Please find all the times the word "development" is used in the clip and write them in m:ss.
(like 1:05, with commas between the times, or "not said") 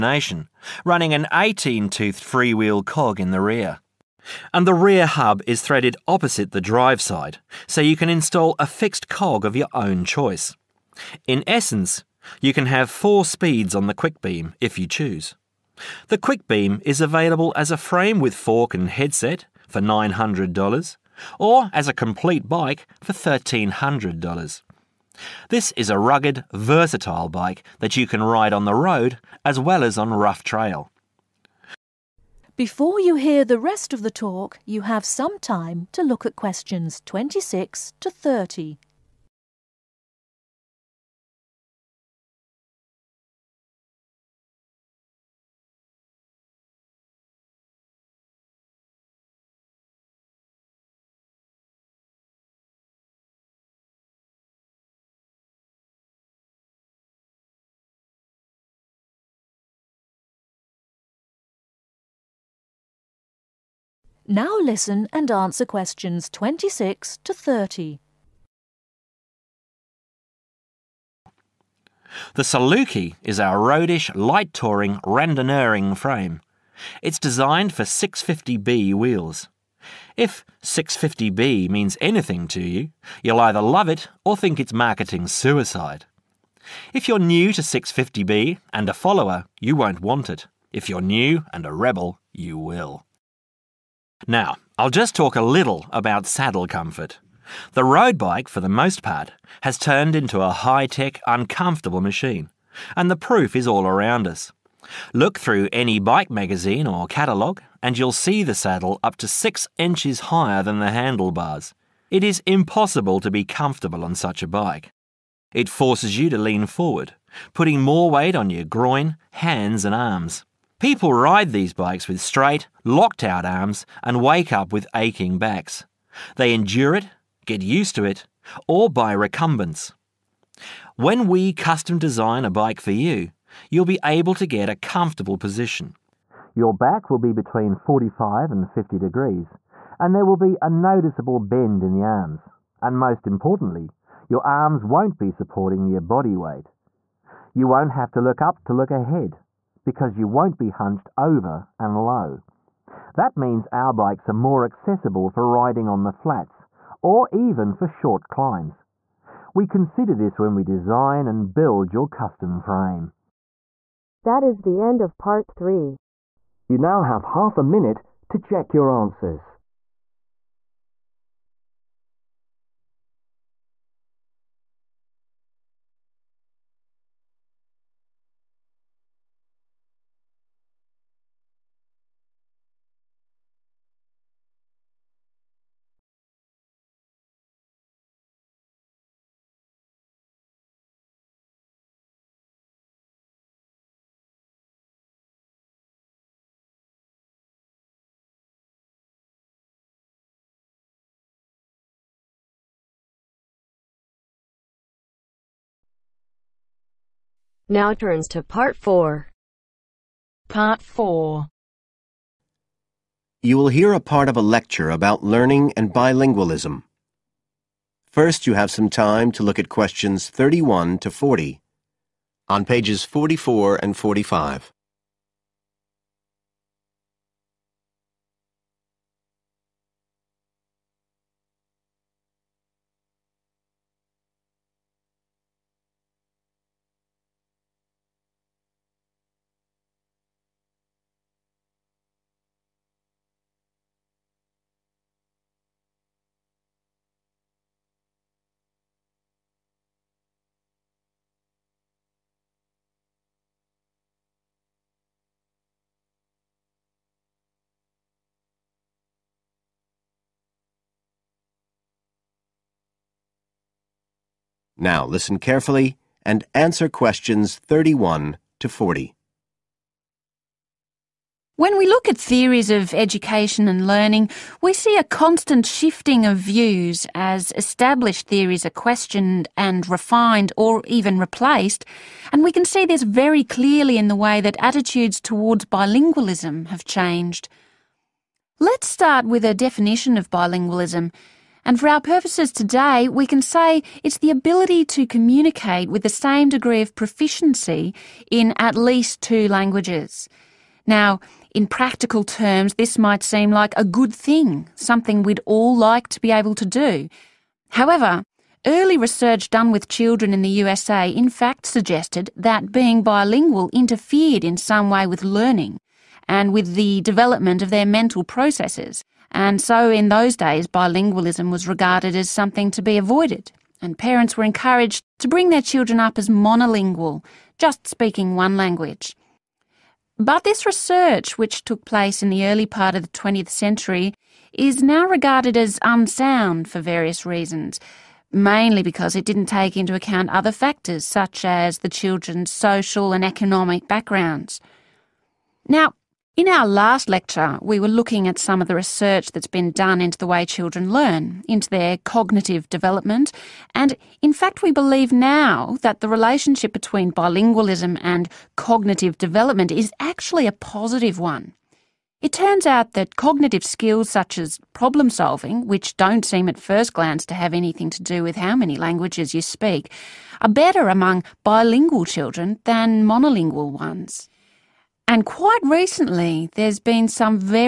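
5:17, 5:52, 5:59.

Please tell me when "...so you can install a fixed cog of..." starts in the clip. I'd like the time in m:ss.
0:07.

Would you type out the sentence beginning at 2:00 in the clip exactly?
People ride these bikes with straight, locked out arms and wake up with aching backs.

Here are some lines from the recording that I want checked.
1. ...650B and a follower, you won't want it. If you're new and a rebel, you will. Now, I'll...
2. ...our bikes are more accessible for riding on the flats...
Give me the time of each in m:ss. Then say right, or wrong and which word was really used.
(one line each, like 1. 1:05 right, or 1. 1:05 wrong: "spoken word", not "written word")
1. 1:27 right
2. 2:33 right.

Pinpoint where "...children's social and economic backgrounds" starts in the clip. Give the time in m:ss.
5:41.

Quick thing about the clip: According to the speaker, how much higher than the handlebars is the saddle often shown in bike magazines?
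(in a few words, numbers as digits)
6 inches.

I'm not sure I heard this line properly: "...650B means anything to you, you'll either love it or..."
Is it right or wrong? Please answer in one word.
right.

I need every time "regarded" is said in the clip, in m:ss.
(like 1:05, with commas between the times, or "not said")
5:21, 5:35.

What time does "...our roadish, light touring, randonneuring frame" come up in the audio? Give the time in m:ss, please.
1:13.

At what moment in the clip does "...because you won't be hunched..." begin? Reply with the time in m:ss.
2:29.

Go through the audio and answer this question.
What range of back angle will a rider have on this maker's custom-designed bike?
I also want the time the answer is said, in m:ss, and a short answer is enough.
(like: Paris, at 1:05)
45 to 50 degrees, at 2:17.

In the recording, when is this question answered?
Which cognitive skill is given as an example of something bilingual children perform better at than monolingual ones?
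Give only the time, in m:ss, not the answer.
6:04.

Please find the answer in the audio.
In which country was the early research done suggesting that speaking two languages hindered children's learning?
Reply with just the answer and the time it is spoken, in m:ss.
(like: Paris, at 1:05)
USA, at 5:10.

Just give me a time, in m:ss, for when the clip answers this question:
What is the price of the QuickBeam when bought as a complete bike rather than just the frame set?
0:23.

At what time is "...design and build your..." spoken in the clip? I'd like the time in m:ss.
2:40.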